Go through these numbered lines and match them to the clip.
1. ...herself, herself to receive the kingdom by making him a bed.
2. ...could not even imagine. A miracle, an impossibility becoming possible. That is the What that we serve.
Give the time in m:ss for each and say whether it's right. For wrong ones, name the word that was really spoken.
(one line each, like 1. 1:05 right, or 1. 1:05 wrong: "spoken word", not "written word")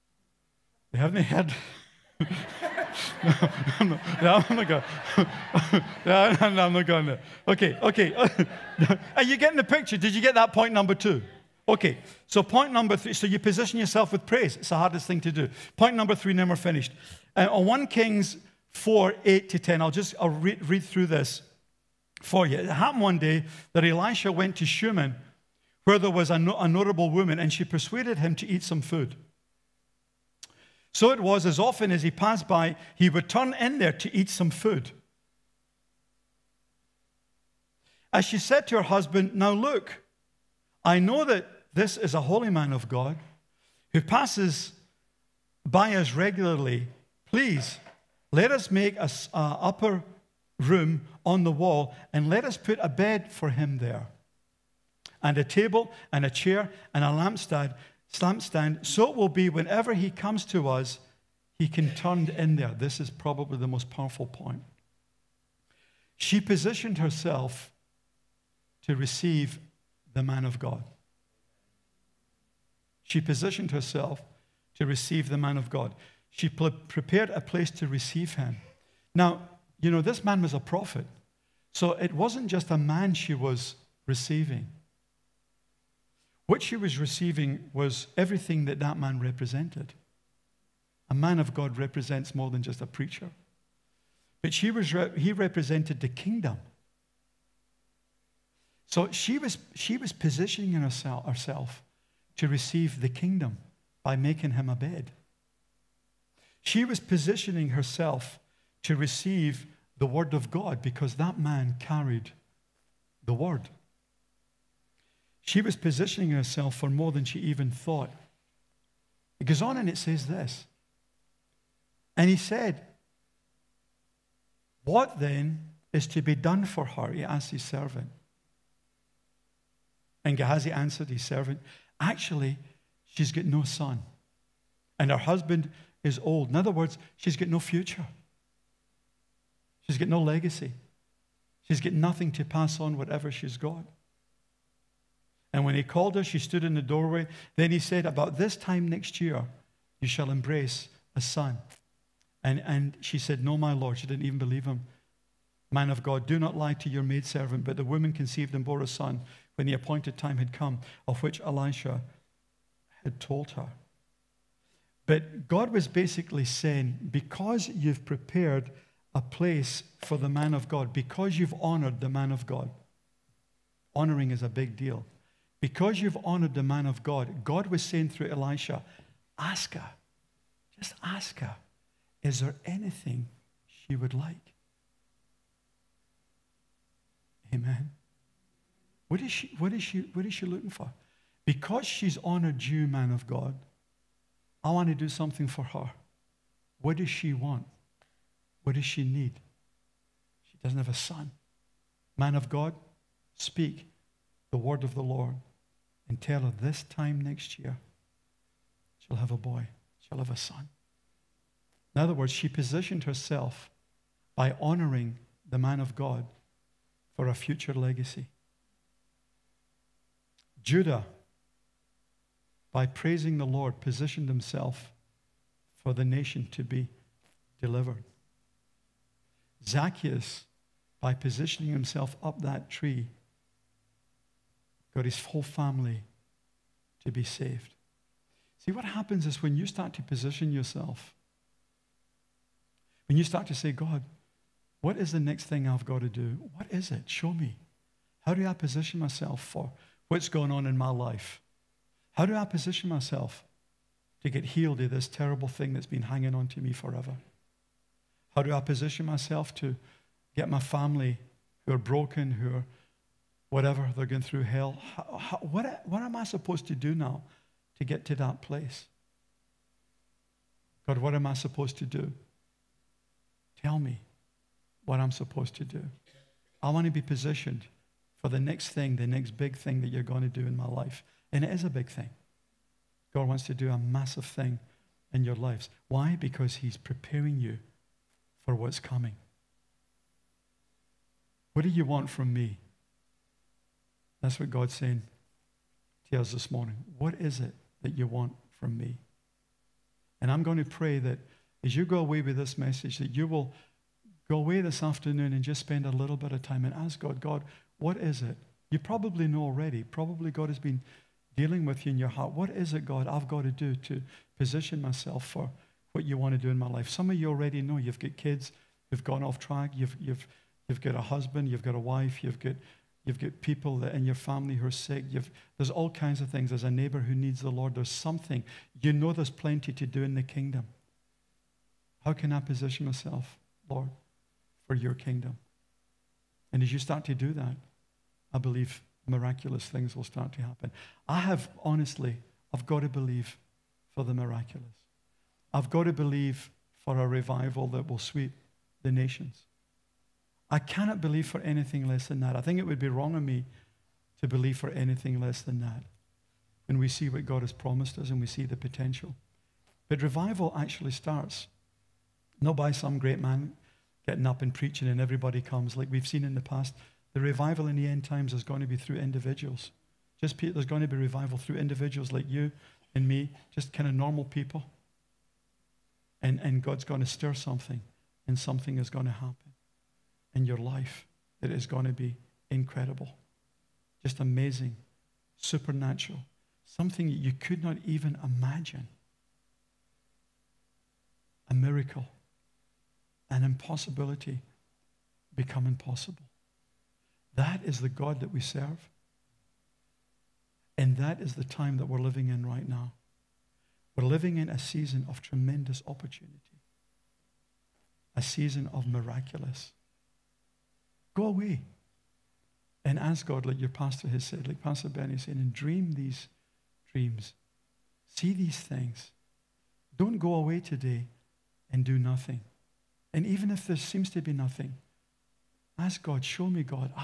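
1. 1:40 right
2. 6:27 wrong: "God", not "What".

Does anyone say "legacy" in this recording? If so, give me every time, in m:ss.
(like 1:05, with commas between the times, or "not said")
2:20, 3:37.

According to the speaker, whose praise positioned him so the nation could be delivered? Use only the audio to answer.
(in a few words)
Judah.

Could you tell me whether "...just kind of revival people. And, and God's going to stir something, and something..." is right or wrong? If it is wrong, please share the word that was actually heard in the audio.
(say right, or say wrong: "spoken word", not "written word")
wrong: "normal", not "revival".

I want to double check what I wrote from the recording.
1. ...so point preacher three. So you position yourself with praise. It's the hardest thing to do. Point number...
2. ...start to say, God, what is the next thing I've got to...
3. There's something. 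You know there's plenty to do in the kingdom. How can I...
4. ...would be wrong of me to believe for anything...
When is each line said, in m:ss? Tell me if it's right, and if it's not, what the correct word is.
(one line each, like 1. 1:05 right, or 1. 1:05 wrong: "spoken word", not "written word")
1. 0:12 wrong: "number", not "preacher"
2. 4:03 right
3. 5:27 right
4. 5:52 right.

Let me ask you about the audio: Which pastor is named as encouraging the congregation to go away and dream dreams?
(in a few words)
Pastor Bernie.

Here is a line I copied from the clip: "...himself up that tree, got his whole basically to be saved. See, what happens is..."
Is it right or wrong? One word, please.
wrong.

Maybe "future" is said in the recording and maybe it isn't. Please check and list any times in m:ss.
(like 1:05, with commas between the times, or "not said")
2:17, 3:37.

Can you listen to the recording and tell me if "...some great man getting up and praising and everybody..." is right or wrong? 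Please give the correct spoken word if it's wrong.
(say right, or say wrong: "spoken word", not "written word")
wrong: "preaching", not "praising".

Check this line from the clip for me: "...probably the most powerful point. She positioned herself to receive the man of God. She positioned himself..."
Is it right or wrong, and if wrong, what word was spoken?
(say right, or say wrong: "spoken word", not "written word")
wrong: "herself", not "himself".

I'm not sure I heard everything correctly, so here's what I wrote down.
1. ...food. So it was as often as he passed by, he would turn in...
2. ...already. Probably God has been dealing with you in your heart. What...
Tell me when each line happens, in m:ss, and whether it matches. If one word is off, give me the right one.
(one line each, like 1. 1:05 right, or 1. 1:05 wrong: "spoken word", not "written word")
1. 0:28 right
2. 5:09 right.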